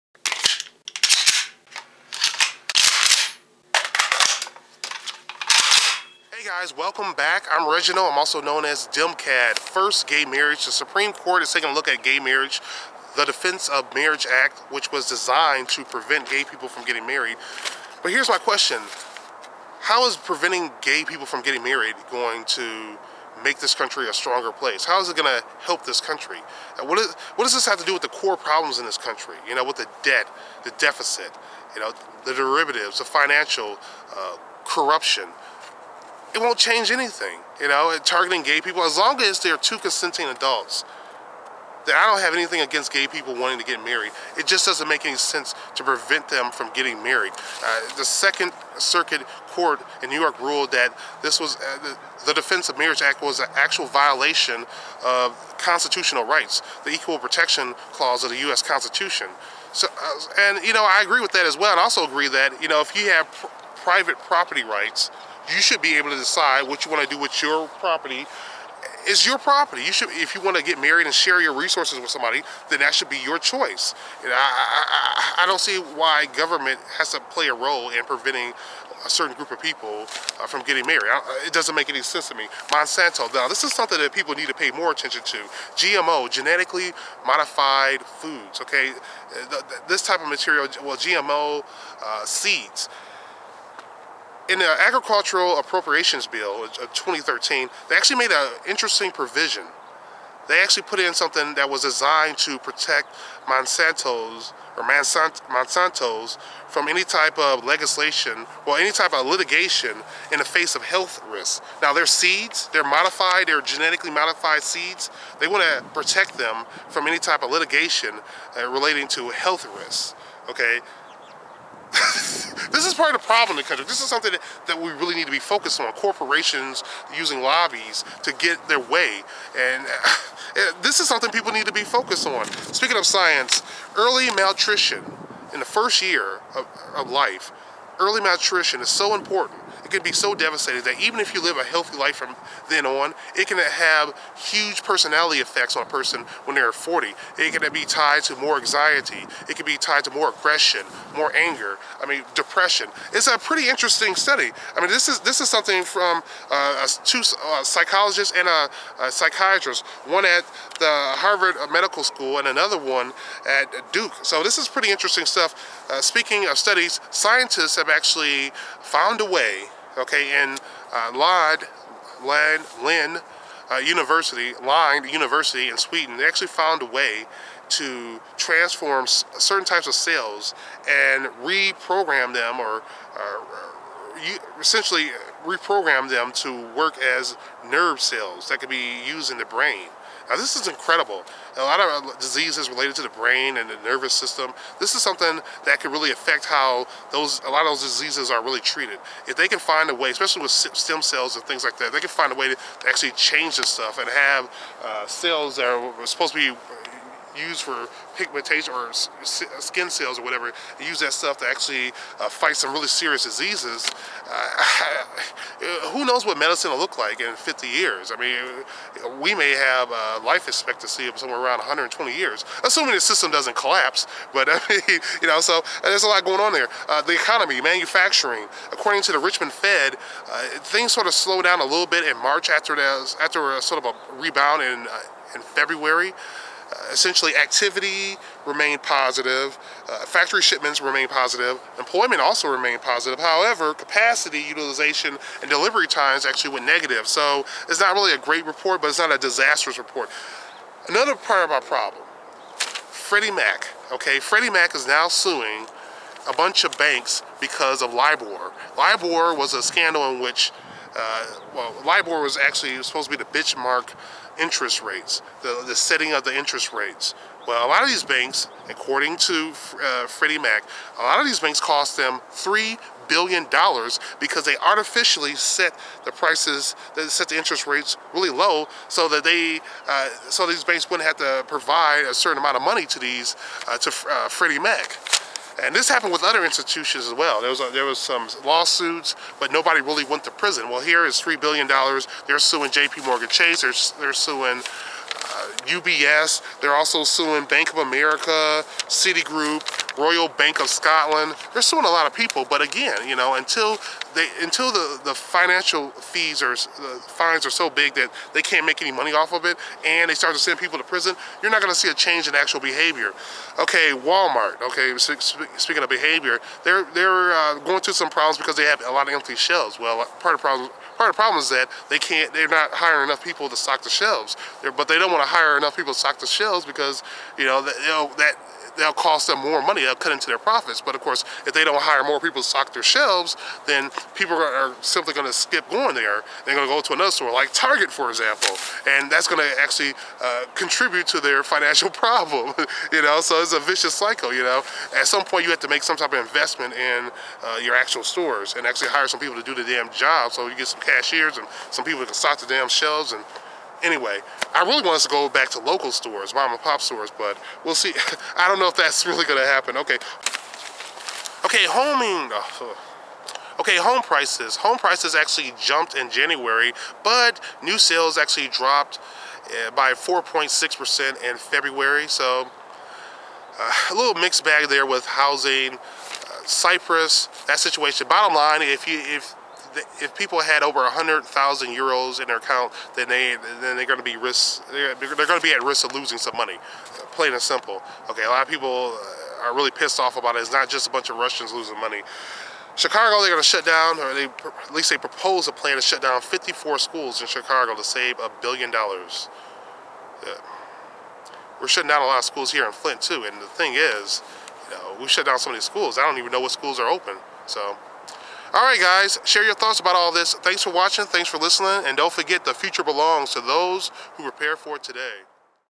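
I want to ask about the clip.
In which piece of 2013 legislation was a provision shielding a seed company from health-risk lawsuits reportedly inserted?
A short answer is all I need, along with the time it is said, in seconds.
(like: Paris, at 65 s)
Agricultural Appropriations Bill, at 94 s.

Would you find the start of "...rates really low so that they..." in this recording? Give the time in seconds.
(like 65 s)
277 s.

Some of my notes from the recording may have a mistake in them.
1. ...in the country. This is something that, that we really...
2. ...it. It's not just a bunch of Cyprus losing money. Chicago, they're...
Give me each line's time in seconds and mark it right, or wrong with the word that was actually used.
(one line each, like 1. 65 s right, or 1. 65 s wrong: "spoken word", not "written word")
1. 123 s right
2. 390 s wrong: "Russians", not "Cyprus".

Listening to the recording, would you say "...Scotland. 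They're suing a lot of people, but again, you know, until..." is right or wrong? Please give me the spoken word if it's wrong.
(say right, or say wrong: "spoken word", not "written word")
right.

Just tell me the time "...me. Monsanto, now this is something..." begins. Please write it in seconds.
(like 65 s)
82 s.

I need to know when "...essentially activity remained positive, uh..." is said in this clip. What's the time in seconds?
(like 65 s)
236 s.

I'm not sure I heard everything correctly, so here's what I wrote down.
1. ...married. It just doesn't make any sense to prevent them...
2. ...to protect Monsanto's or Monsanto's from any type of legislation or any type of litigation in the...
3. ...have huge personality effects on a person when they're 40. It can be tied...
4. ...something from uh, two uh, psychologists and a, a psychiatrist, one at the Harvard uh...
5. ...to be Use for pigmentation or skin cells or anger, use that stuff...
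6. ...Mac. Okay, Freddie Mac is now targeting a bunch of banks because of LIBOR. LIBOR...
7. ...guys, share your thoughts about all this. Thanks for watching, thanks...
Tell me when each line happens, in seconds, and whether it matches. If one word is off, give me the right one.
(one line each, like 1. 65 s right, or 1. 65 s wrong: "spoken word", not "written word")
1. 43 s right
2. 102 s right
3. 143 s right
4. 155 s right
5. 206 s wrong: "whatever", not "anger"
6. 253 s wrong: "suing", not "targeting"
7. 408 s right.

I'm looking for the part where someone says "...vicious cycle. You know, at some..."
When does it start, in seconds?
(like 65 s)
343 s.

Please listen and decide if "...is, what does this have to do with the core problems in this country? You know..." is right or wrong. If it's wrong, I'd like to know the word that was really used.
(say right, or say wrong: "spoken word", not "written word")
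right.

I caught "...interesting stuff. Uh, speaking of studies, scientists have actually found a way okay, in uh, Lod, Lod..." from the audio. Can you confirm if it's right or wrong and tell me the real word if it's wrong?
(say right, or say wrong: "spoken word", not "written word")
right.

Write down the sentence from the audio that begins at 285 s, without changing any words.
And this happened with other institutions as well.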